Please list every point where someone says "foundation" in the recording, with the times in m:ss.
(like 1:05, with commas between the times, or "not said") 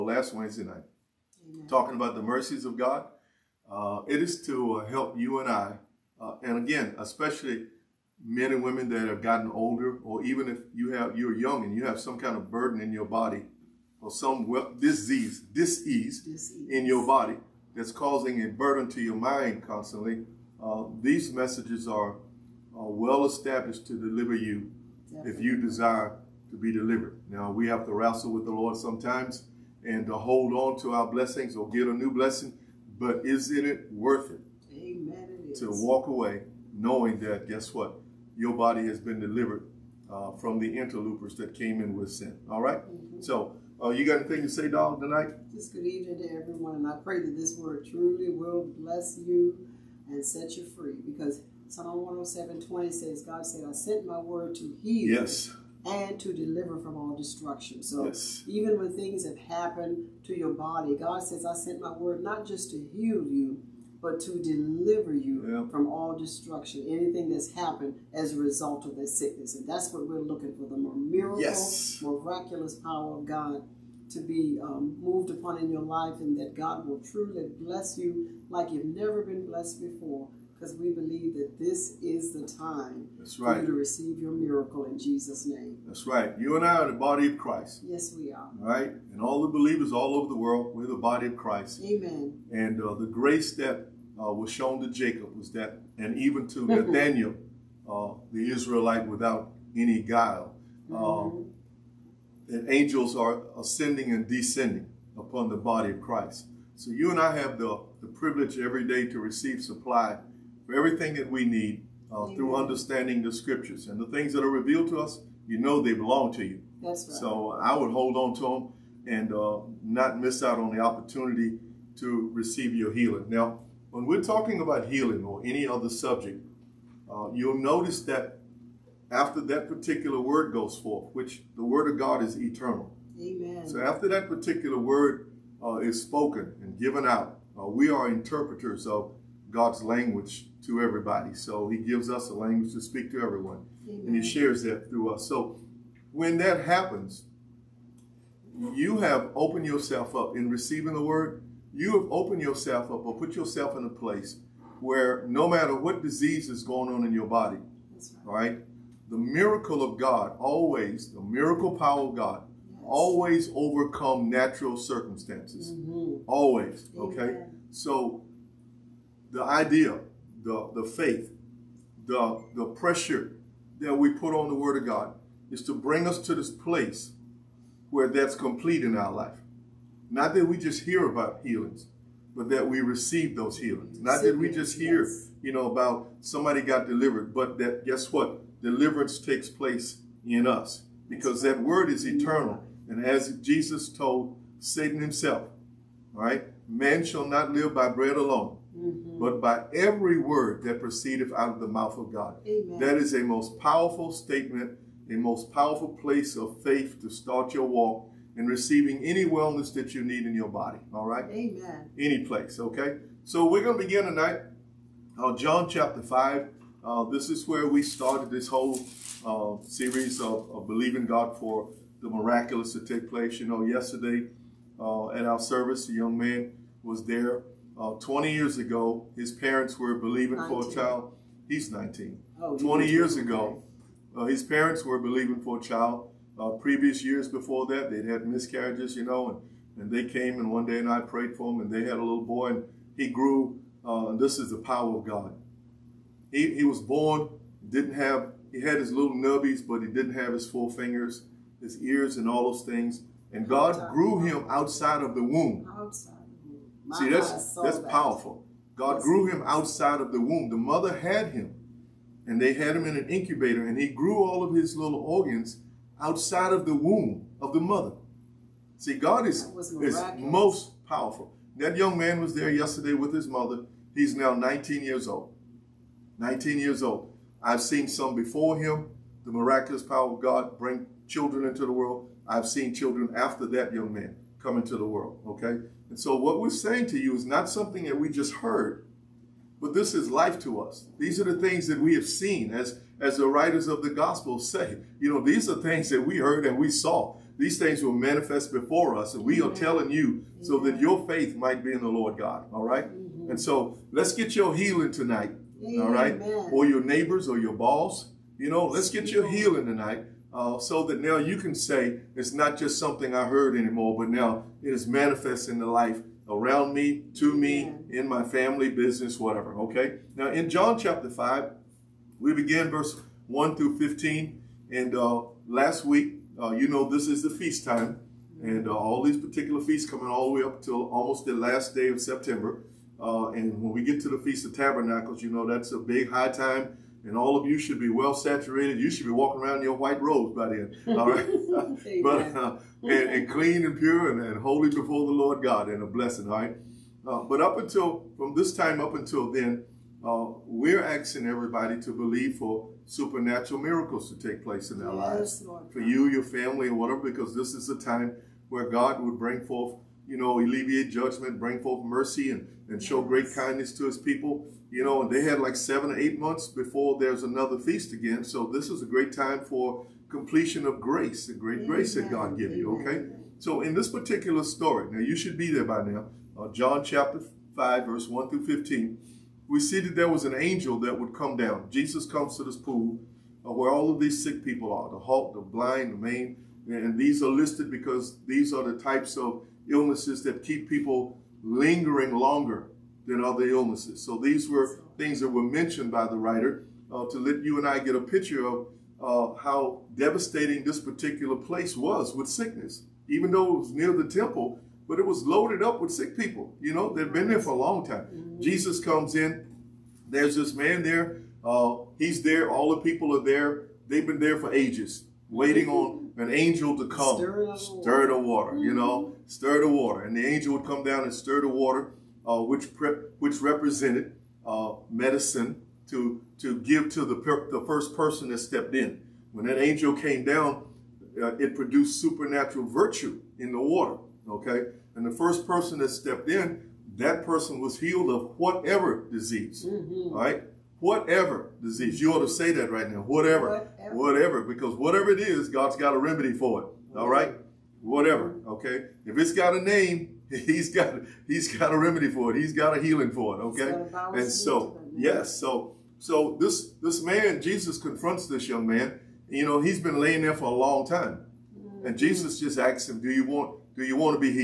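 not said.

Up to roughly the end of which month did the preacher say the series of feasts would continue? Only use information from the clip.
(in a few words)
September.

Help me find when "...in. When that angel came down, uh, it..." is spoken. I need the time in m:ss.
7:08.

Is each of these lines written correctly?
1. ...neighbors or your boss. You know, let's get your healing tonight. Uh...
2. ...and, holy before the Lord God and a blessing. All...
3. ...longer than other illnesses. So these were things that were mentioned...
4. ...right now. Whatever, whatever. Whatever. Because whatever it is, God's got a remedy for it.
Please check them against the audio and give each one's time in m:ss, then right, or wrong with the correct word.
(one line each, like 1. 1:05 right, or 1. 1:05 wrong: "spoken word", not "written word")
1. 5:06 right
2. 5:44 right
3. 6:32 right
4. 7:22 right.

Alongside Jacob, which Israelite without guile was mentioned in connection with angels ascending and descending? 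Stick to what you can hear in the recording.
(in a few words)
Nathaniel.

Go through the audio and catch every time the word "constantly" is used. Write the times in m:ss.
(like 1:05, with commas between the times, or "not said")
0:19.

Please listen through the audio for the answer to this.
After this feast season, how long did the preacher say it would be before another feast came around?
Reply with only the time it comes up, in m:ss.
6:05.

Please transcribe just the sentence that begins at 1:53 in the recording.
And the things that are revealed to us, you know they belong to you.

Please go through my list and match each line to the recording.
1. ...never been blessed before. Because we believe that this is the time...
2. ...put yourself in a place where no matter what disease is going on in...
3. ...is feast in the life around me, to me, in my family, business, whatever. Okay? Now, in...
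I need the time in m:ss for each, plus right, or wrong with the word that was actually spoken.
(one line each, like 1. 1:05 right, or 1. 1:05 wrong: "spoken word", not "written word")
1. 1:18 right
2. 2:33 right
3. 5:14 wrong: "manifest", not "feast".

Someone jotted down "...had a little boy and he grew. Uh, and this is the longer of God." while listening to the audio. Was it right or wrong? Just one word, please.
wrong.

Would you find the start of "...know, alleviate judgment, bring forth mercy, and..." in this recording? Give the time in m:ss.
6:00.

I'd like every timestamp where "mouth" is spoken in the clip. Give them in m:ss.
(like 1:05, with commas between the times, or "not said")
3:21.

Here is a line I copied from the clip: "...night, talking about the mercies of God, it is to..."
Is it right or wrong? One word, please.
right.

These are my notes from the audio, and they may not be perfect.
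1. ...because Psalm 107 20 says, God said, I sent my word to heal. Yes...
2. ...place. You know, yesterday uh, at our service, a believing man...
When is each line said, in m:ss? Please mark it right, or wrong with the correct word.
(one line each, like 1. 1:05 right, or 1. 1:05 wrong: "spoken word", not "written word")
1. 0:51 right
2. 3:43 wrong: "young", not "believing".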